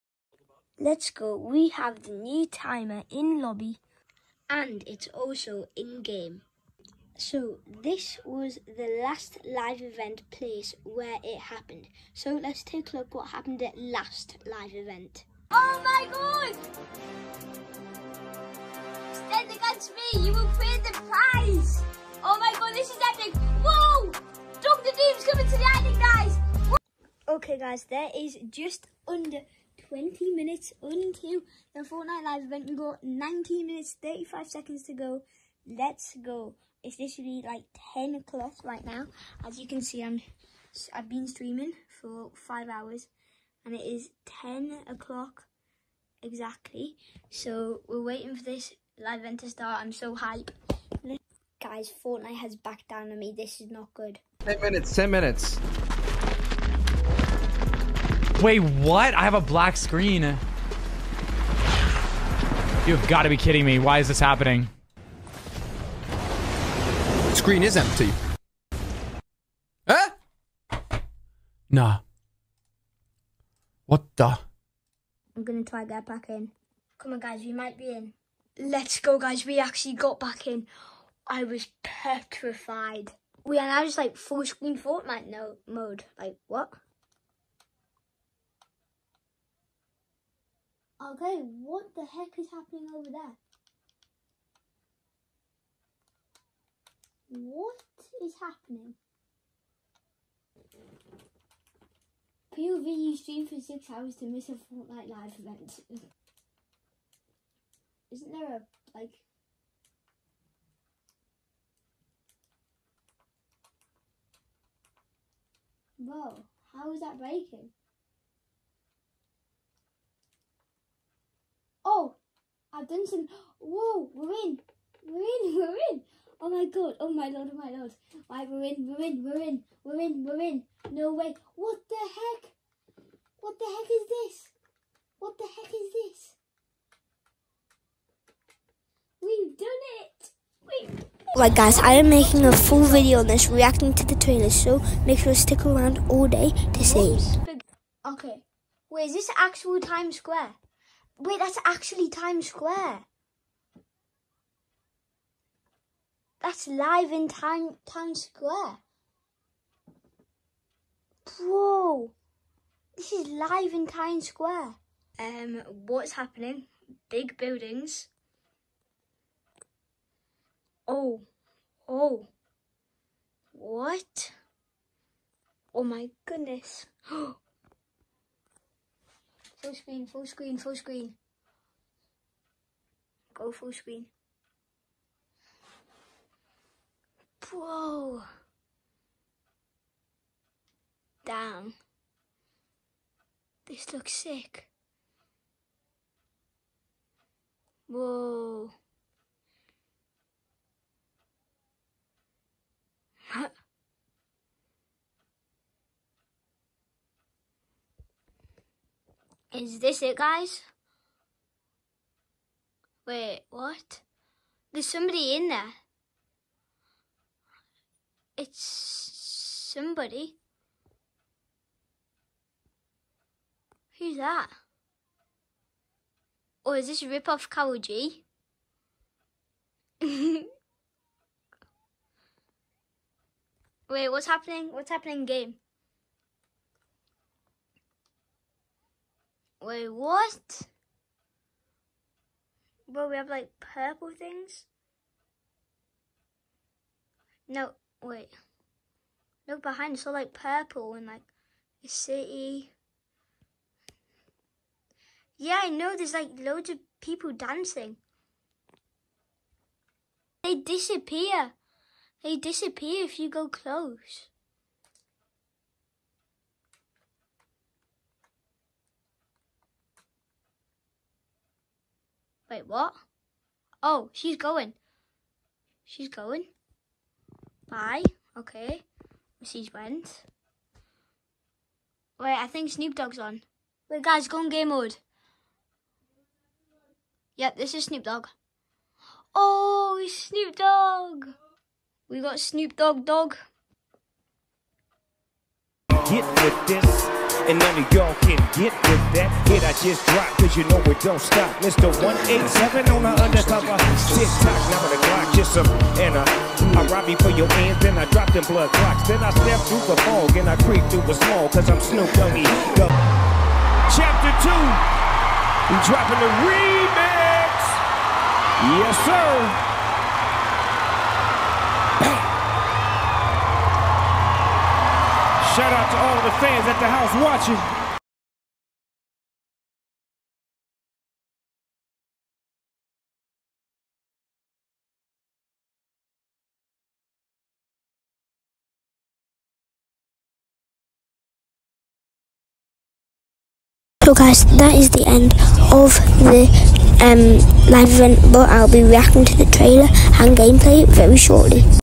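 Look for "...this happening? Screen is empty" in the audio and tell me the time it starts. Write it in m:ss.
1:04.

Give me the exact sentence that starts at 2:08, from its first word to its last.
Why we're in, we're in, we're in, we're in, we're in.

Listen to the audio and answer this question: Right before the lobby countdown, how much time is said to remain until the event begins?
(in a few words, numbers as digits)
19 minutes, 35 seconds.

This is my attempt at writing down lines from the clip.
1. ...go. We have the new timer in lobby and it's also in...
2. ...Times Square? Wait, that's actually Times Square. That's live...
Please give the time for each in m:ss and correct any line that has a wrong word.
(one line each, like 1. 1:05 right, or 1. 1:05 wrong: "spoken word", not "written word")
1. 0:01 right
2. 2:29 right.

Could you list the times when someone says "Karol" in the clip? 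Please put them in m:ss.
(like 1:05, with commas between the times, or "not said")
3:47.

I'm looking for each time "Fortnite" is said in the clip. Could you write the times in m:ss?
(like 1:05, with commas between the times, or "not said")
0:31, 0:52, 1:24, 1:44.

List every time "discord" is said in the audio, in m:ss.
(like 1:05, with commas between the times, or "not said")
not said.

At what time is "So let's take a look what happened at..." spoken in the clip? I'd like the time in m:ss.
0:12.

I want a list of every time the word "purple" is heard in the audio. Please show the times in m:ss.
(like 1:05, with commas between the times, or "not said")
4:03, 4:10.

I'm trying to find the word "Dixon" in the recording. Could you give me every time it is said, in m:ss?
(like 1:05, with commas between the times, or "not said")
not said.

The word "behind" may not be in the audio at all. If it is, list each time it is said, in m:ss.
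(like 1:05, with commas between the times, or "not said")
4:09.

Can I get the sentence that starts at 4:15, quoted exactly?
Yeah, I know there's like loads of people dancing.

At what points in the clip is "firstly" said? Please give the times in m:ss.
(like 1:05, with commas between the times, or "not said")
not said.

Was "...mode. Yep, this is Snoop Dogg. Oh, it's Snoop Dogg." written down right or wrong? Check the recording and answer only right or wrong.
right.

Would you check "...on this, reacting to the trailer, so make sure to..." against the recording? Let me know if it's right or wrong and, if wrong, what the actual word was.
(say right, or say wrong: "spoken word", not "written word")
right.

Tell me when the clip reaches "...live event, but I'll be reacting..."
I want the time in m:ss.
5:47.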